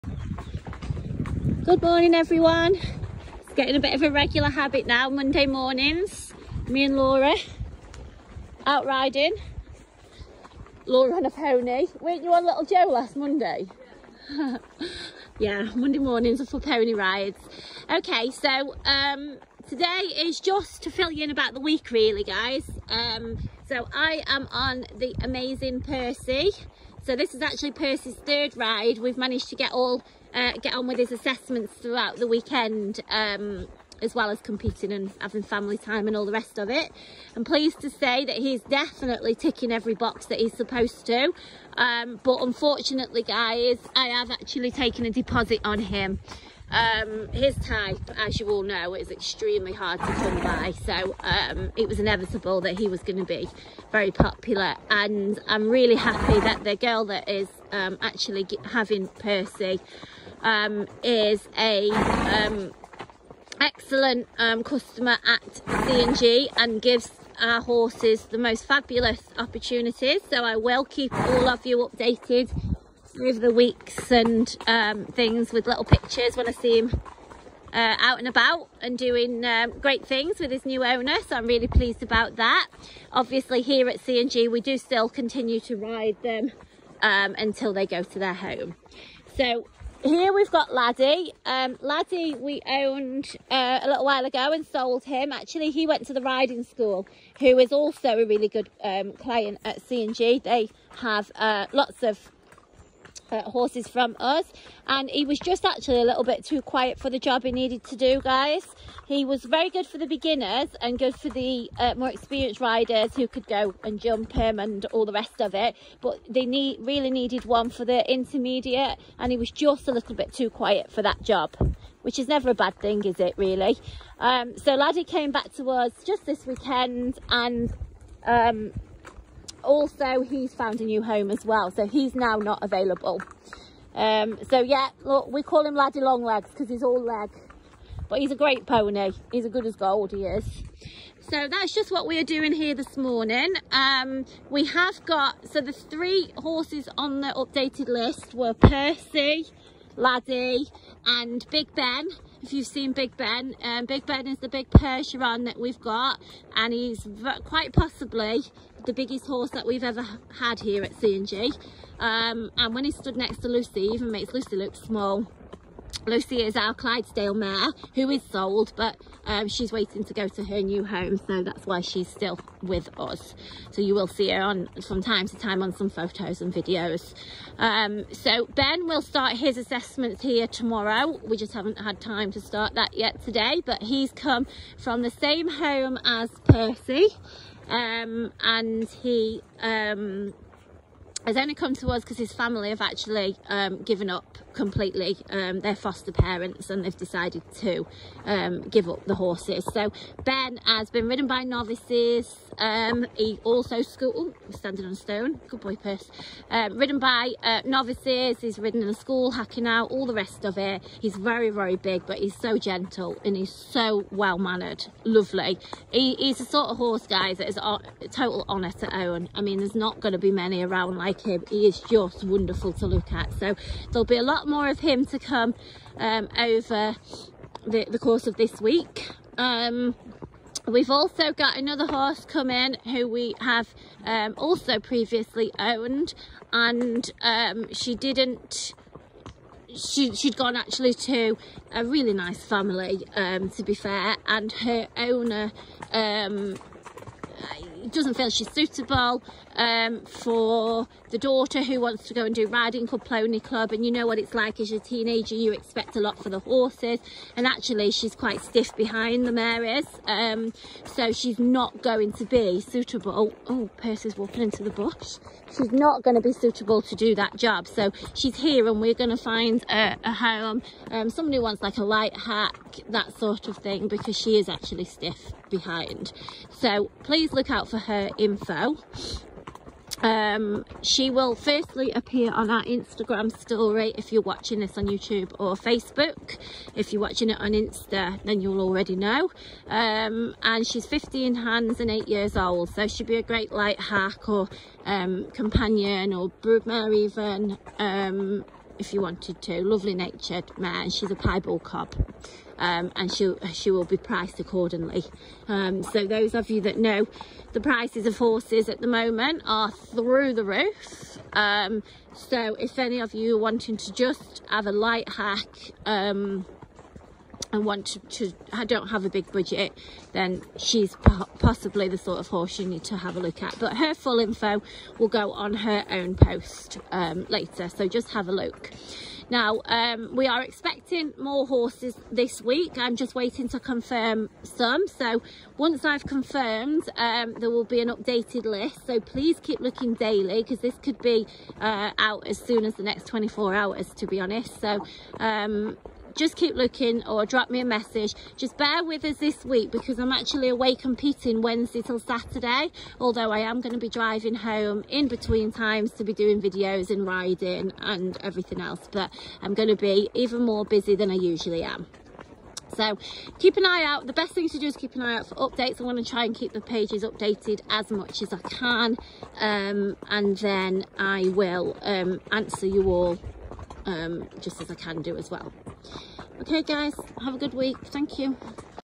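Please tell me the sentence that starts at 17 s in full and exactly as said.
Okay, so um, today is just to fill you in about the week really, guys.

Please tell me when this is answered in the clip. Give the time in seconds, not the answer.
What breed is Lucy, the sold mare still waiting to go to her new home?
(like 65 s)
166 s.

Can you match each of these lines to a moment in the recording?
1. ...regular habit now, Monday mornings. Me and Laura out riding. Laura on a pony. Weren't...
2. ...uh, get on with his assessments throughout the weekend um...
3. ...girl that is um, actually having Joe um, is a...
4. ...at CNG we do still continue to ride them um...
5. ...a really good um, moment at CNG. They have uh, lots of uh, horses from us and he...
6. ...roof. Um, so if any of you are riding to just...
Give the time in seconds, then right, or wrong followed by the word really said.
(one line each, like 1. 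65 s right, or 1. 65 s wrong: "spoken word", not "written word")
1. 4 s right
2. 30 s right
3. 56 s wrong: "Percy", not "Joe"
4. 83 s right
5. 98 s wrong: "client", not "moment"
6. 310 s wrong: "wanting", not "riding".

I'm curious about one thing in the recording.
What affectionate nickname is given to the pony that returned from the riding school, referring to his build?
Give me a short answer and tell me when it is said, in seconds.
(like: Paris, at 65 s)
Laddie Long Legs, at 135 s.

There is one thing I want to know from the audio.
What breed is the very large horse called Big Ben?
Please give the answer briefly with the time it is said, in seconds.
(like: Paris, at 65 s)
Percheron, at 154 s.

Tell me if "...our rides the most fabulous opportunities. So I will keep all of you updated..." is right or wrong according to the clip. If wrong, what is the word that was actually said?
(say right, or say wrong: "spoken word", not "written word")
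wrong: "horses", not "rides".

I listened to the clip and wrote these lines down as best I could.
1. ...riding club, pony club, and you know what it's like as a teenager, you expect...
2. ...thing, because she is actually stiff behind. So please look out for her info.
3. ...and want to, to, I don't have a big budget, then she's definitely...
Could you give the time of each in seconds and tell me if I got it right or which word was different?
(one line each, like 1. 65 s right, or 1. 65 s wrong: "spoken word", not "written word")
1. 252 s right
2. 273 s right
3. 317 s wrong: "possibly", not "definitely".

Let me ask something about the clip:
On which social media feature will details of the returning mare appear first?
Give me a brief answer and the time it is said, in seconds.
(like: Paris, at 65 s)
Instagram story, at 282 s.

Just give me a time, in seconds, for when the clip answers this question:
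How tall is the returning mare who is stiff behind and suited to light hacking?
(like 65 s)
290 s.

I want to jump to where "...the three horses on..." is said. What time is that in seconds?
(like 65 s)
145 s.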